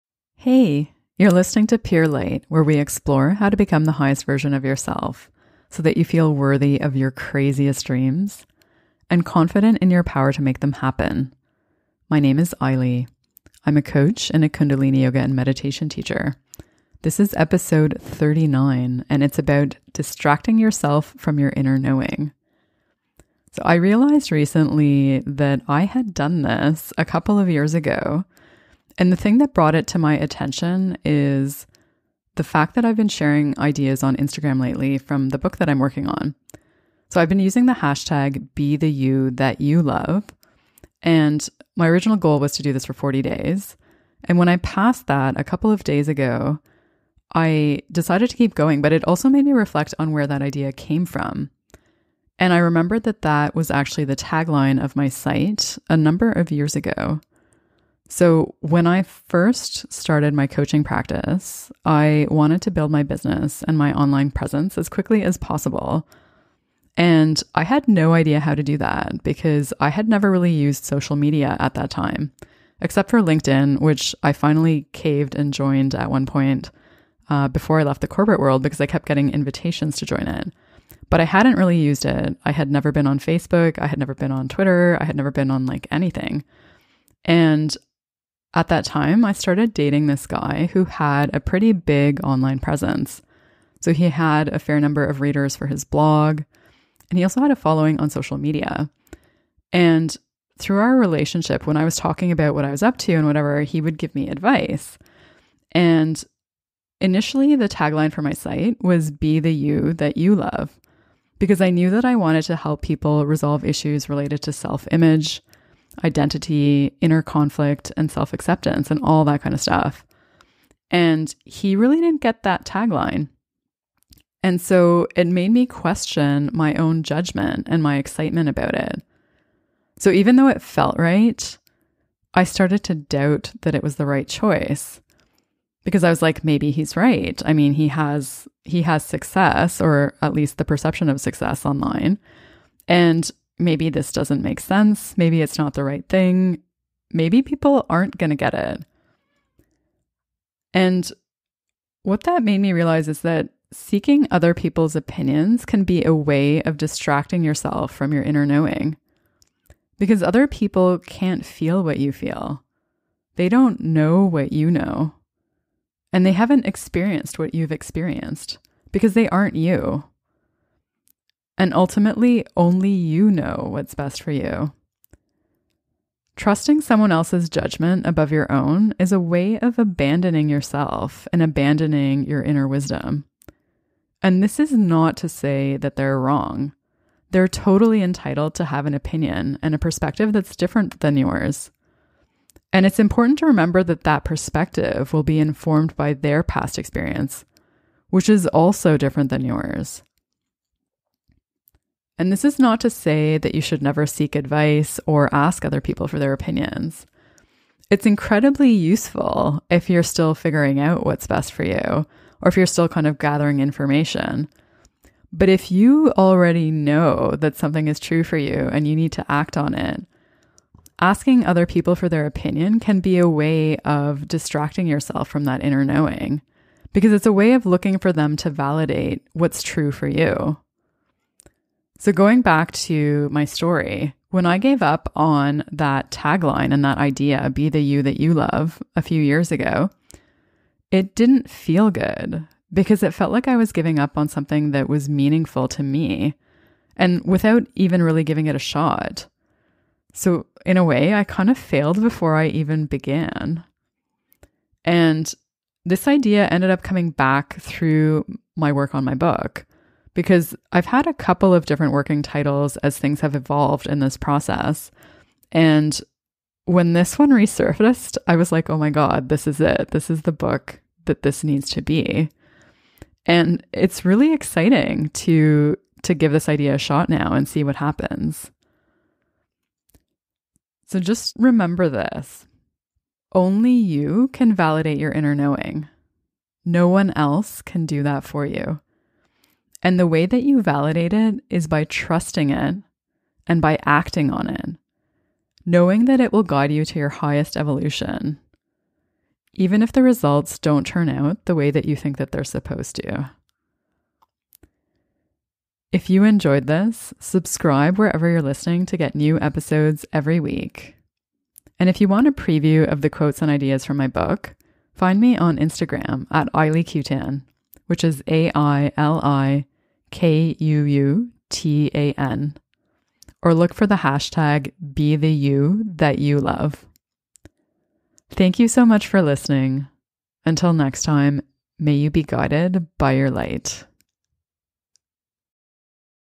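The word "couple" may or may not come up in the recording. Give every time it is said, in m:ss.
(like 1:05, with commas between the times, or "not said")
0:27, 0:45, 4:21.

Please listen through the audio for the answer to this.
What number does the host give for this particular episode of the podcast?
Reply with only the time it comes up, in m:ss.
0:18.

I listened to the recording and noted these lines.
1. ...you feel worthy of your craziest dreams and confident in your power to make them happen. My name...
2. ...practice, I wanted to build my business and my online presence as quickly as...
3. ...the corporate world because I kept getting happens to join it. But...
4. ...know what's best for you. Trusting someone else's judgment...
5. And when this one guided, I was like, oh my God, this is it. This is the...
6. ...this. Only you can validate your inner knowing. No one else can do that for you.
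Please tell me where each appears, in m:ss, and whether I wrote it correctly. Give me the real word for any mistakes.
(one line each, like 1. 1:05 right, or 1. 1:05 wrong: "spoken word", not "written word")
1. 0:05 right
2. 1:00 right
3. 1:18 wrong: "invitations", not "happens"
4. 2:53 right
5. 4:25 wrong: "resurfaced", not "guided"
6. 4:41 right.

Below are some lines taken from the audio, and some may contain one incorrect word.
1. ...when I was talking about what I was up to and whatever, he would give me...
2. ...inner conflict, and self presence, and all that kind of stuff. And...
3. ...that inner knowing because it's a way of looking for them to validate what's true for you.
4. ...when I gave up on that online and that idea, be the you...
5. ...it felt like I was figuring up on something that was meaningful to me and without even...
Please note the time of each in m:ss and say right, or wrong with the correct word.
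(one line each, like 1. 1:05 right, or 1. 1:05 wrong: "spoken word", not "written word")
1. 1:41 right
2. 1:57 wrong: "acceptance", not "presence"
3. 3:45 right
4. 3:54 wrong: "tagline", not "online"
5. 4:03 wrong: "giving", not "figuring".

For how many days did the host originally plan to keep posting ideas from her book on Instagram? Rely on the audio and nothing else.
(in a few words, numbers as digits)
40.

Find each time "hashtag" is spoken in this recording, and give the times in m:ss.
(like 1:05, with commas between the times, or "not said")
0:37, 5:23.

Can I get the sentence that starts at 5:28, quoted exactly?
Thank you so much for listening.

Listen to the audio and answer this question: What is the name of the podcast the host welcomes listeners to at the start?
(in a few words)
Pure Light.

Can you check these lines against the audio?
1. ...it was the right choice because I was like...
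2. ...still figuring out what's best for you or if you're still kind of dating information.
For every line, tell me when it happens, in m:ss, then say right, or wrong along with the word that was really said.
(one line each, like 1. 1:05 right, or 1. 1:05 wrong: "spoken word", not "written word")
1. 2:13 right
2. 3:30 wrong: "gathering", not "dating".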